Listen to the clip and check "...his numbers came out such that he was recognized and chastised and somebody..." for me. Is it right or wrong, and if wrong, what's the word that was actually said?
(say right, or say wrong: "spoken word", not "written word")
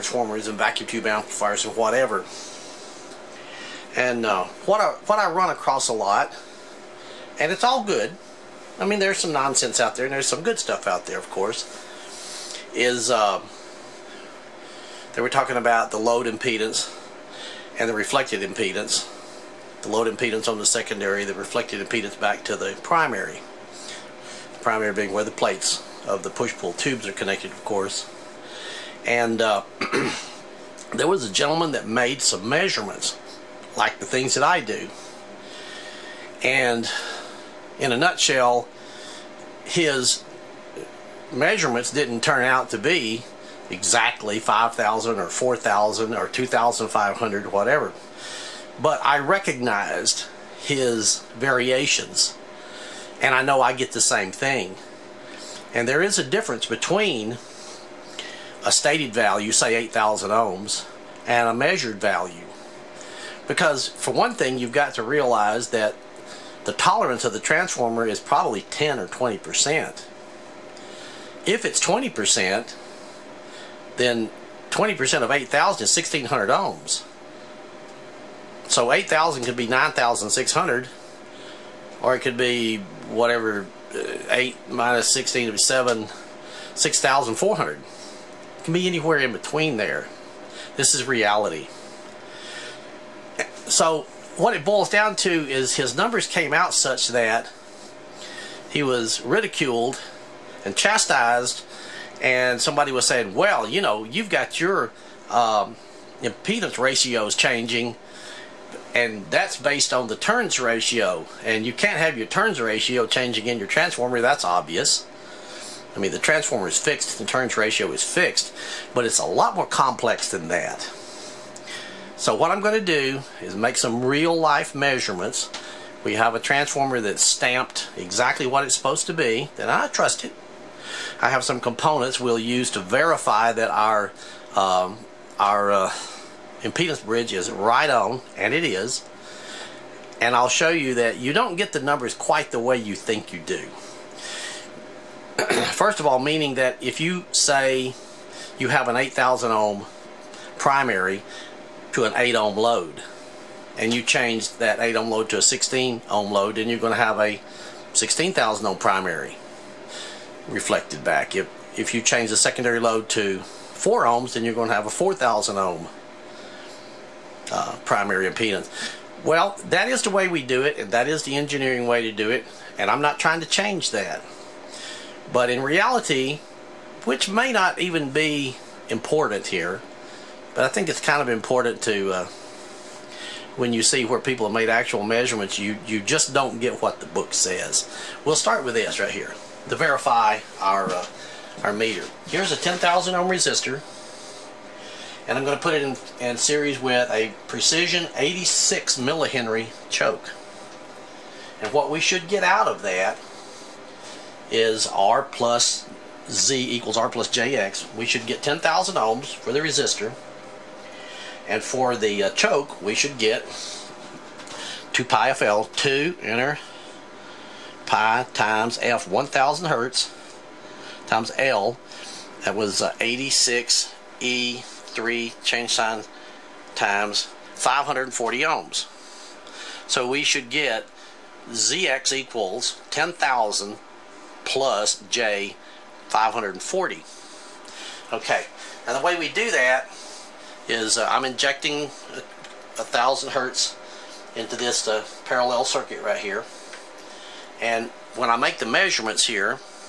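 wrong: "ridiculed", not "recognized".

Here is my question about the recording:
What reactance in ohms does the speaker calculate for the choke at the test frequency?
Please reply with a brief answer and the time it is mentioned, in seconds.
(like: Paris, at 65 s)
540 ohms, at 227 s.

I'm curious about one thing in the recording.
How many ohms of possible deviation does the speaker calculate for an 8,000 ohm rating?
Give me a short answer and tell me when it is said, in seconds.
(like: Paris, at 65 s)
1,600 ohms, at 75 s.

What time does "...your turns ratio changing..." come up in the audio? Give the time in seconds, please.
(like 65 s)
112 s.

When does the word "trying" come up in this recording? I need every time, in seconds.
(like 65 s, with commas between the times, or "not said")
173 s.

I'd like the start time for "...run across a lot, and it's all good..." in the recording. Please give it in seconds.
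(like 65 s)
5 s.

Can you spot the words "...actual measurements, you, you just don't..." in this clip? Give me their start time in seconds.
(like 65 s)
184 s.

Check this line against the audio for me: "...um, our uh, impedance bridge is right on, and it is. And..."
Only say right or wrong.
right.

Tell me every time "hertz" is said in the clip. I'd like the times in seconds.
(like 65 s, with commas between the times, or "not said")
219 s, 243 s.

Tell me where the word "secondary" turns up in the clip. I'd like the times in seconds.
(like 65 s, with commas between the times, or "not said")
20 s, 162 s.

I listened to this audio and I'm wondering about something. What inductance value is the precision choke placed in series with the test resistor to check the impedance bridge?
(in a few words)
86 millihenry.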